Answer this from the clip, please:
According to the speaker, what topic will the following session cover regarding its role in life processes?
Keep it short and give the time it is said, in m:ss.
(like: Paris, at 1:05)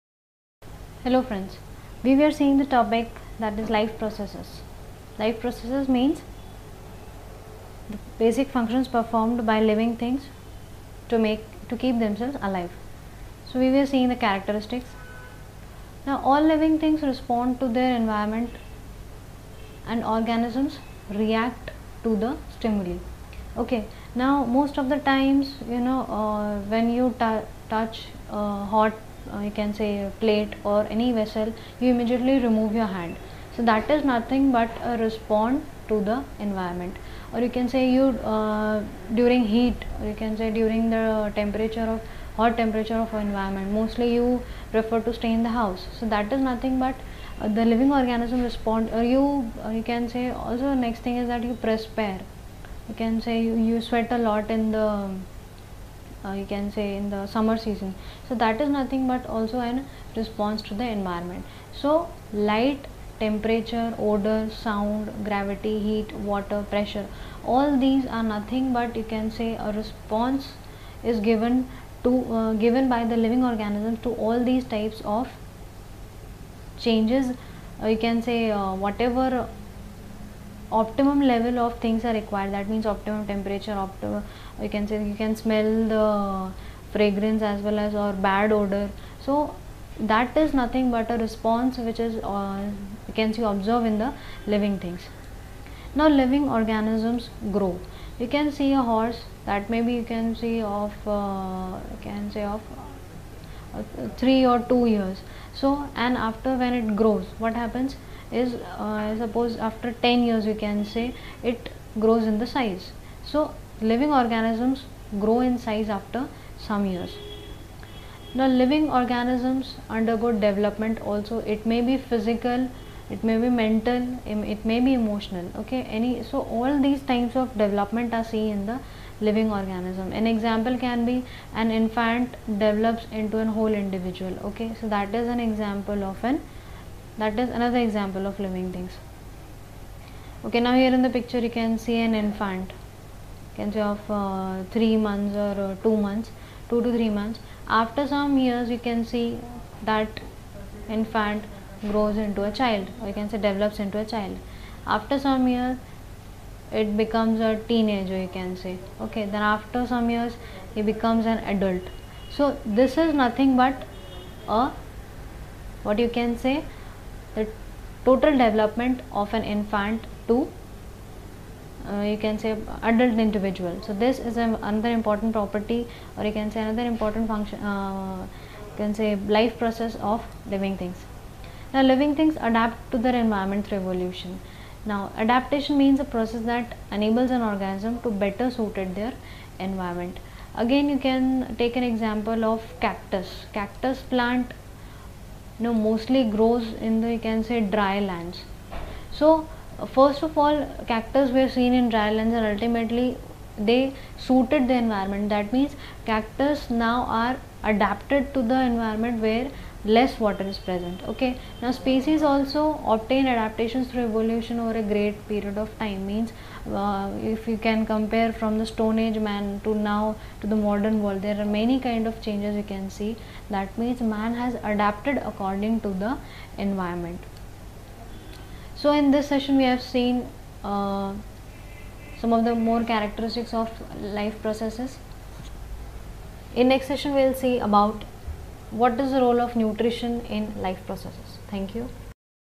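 Nutrition, at 3:59.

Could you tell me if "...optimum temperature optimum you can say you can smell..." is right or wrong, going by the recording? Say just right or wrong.
right.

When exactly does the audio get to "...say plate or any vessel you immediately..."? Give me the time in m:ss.
0:29.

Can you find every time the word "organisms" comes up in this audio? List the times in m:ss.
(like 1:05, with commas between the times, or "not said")
0:20, 0:47, 1:13, 1:36, 1:54, 1:58, 2:09, 3:07.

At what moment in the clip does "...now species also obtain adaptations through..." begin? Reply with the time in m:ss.
3:31.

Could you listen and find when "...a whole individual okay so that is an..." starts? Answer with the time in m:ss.
2:13.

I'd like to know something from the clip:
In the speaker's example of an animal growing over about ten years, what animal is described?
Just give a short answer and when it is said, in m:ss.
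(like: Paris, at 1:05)
Horse, at 1:38.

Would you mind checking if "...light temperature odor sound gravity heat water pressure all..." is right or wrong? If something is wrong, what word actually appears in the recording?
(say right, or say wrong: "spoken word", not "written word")
right.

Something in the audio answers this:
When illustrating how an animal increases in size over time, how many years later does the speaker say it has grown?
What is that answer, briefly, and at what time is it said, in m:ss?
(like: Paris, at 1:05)
10, at 1:50.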